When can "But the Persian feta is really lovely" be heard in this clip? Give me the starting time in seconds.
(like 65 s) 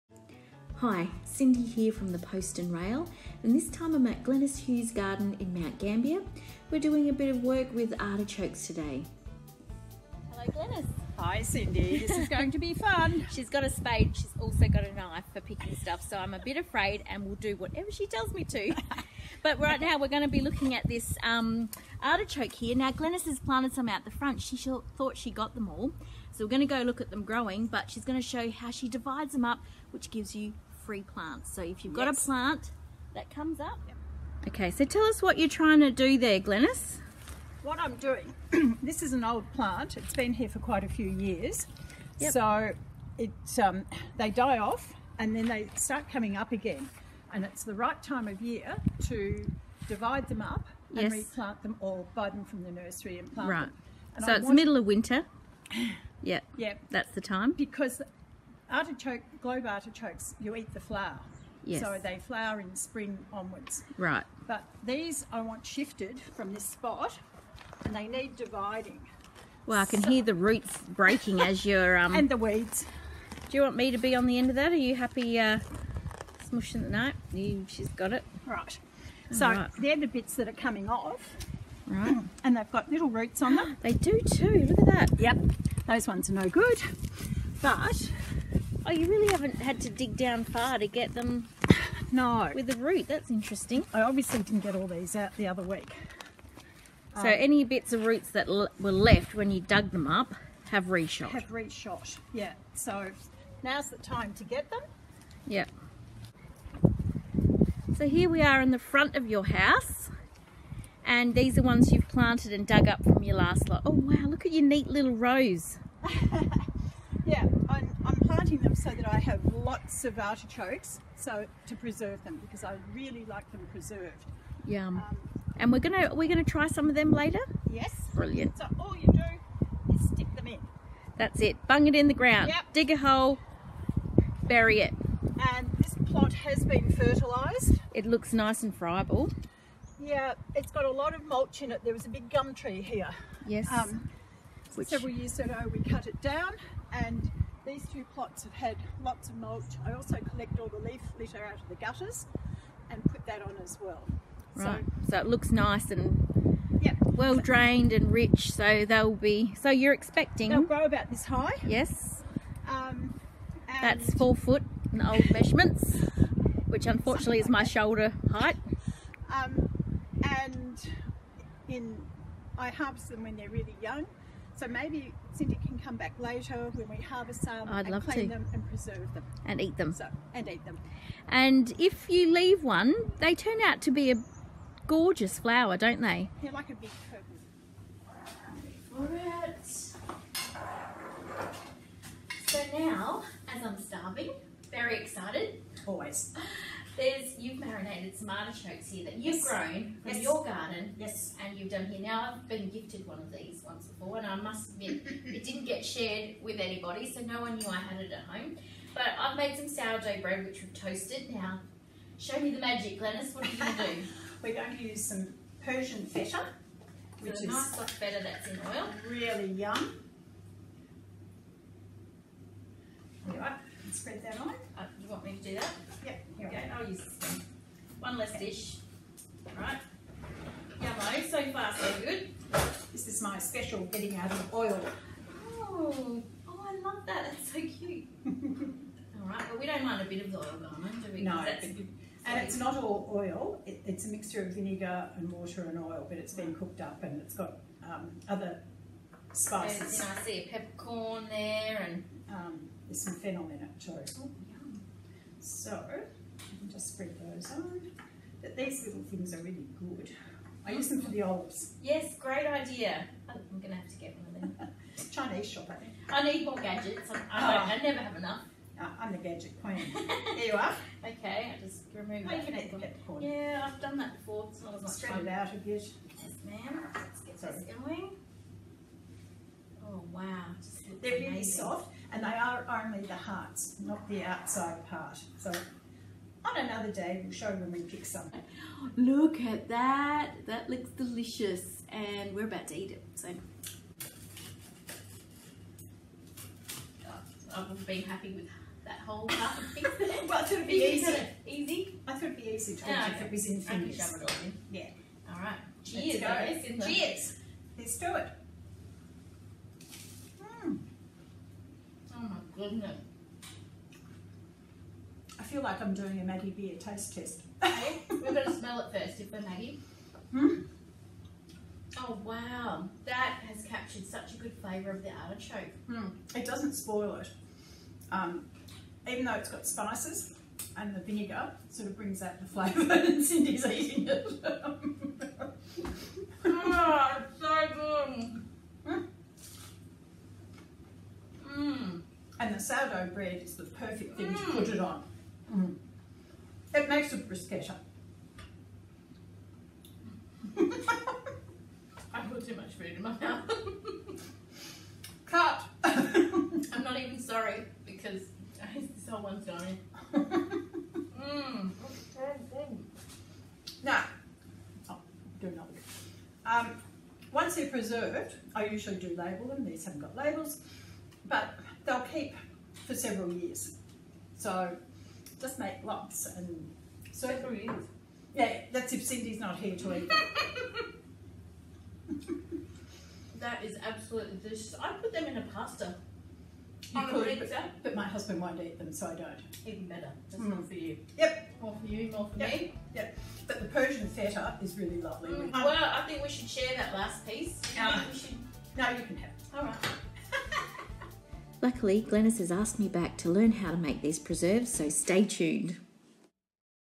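393 s.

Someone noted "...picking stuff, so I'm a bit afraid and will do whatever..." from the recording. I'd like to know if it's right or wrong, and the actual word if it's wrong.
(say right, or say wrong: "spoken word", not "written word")
right.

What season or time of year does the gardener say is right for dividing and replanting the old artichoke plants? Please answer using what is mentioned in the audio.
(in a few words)
Middle of winter.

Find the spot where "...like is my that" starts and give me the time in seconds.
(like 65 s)
167 s.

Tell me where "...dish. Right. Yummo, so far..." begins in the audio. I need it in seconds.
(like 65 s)
228 s.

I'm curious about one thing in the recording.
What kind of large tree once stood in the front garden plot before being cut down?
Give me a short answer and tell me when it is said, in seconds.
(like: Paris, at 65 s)
Gum tree, at 142 s.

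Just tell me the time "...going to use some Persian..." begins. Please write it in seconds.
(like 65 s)
214 s.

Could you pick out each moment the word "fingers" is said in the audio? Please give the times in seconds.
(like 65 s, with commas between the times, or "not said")
303 s.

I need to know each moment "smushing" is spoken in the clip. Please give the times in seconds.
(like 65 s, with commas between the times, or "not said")
76 s.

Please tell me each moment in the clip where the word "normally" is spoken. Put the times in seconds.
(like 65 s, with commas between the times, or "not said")
not said.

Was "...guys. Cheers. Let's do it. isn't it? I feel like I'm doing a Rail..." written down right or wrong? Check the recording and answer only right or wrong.
wrong.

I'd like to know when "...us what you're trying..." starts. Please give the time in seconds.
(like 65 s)
35 s.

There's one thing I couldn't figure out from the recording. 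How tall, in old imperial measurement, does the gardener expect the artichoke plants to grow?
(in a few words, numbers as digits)
4 feet.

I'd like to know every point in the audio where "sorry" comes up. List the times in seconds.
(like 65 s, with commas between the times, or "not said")
277 s, 357 s.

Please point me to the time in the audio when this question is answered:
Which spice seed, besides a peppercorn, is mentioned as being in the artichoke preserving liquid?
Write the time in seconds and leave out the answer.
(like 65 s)
253 s.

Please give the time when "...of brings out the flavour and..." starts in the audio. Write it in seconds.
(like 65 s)
331 s.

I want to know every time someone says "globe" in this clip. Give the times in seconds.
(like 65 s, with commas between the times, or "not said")
59 s.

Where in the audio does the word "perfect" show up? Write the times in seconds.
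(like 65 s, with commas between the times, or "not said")
343 s.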